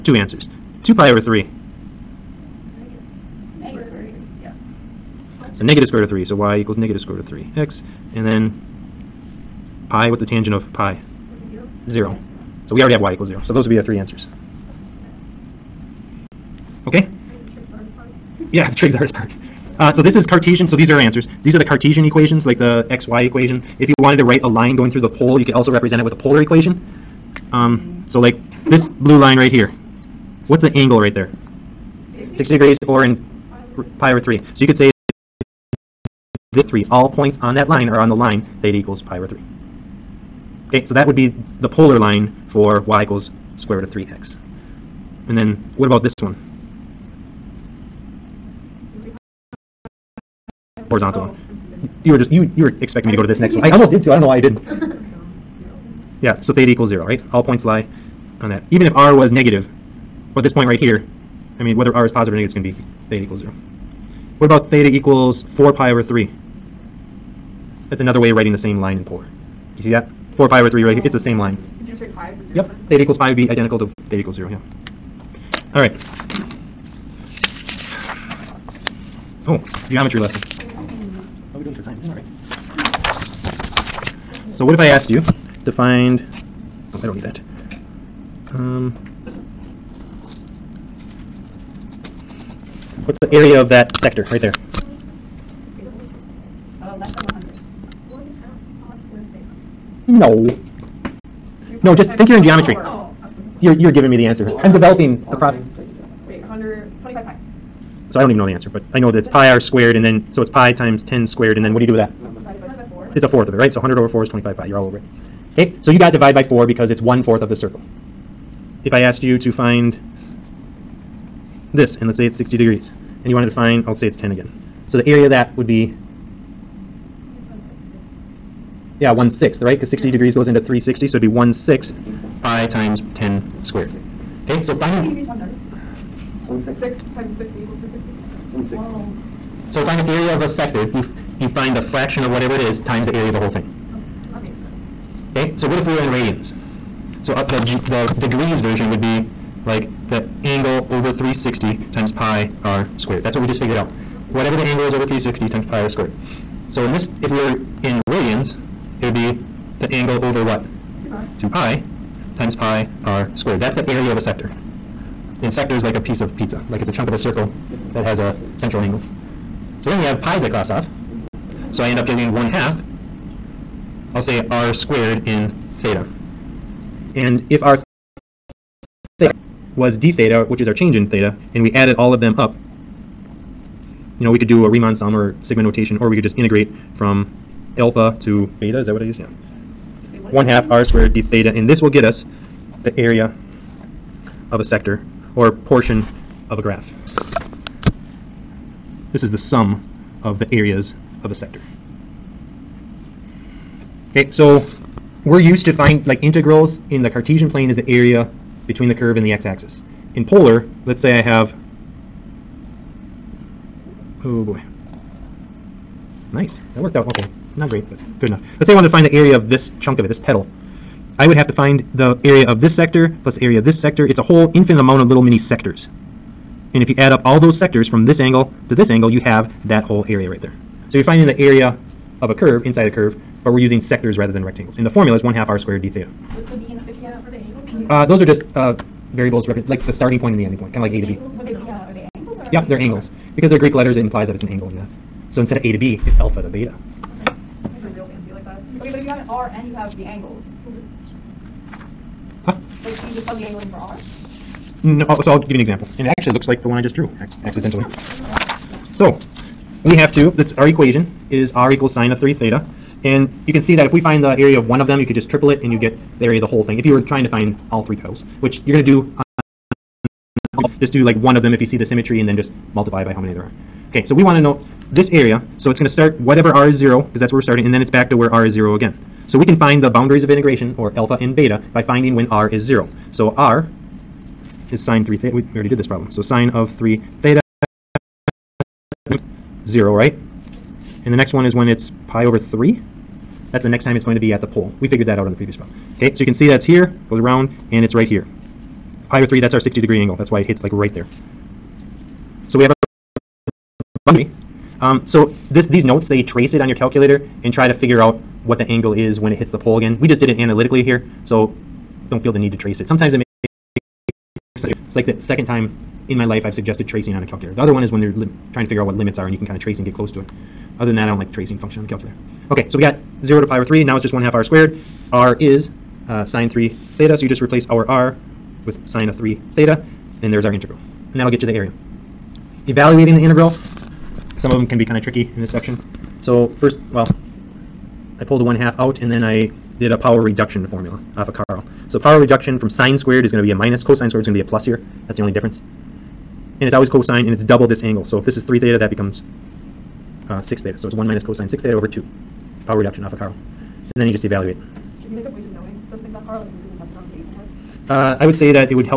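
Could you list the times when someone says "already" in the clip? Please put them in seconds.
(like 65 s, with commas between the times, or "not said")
12 s, 285 s.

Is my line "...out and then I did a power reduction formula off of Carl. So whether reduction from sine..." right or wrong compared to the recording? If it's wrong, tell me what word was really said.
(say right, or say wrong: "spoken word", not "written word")
wrong: "power", not "whether".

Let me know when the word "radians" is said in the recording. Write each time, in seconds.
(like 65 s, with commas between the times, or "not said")
146 s, 158 s.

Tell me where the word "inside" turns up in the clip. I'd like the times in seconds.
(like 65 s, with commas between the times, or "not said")
232 s.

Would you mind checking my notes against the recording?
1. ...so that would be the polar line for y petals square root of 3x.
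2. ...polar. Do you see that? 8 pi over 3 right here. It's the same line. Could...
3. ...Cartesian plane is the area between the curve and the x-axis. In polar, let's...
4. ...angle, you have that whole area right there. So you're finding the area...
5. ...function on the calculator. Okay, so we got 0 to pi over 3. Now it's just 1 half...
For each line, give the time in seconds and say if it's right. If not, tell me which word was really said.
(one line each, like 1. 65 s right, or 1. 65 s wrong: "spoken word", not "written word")
1. 40 s wrong: "equals", not "petals"
2. 69 s wrong: "4", not "8"
3. 207 s right
4. 228 s right
5. 321 s right.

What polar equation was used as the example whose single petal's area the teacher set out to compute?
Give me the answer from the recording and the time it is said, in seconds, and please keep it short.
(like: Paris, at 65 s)
r = sin 3θ, at 261 s.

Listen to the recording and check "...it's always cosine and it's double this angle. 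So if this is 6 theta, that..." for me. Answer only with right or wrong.
wrong.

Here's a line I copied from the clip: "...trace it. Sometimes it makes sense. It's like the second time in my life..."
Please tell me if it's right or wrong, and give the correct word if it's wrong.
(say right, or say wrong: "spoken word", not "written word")
right.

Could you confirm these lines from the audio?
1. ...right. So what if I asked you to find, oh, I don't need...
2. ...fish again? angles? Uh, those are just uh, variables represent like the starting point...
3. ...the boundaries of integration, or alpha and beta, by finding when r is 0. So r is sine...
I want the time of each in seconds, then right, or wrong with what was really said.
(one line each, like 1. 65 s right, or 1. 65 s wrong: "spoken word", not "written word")
1. 82 s right
2. 236 s right
3. 279 s right.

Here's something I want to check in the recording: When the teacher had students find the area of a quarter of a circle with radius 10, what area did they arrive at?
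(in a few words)
25 pi.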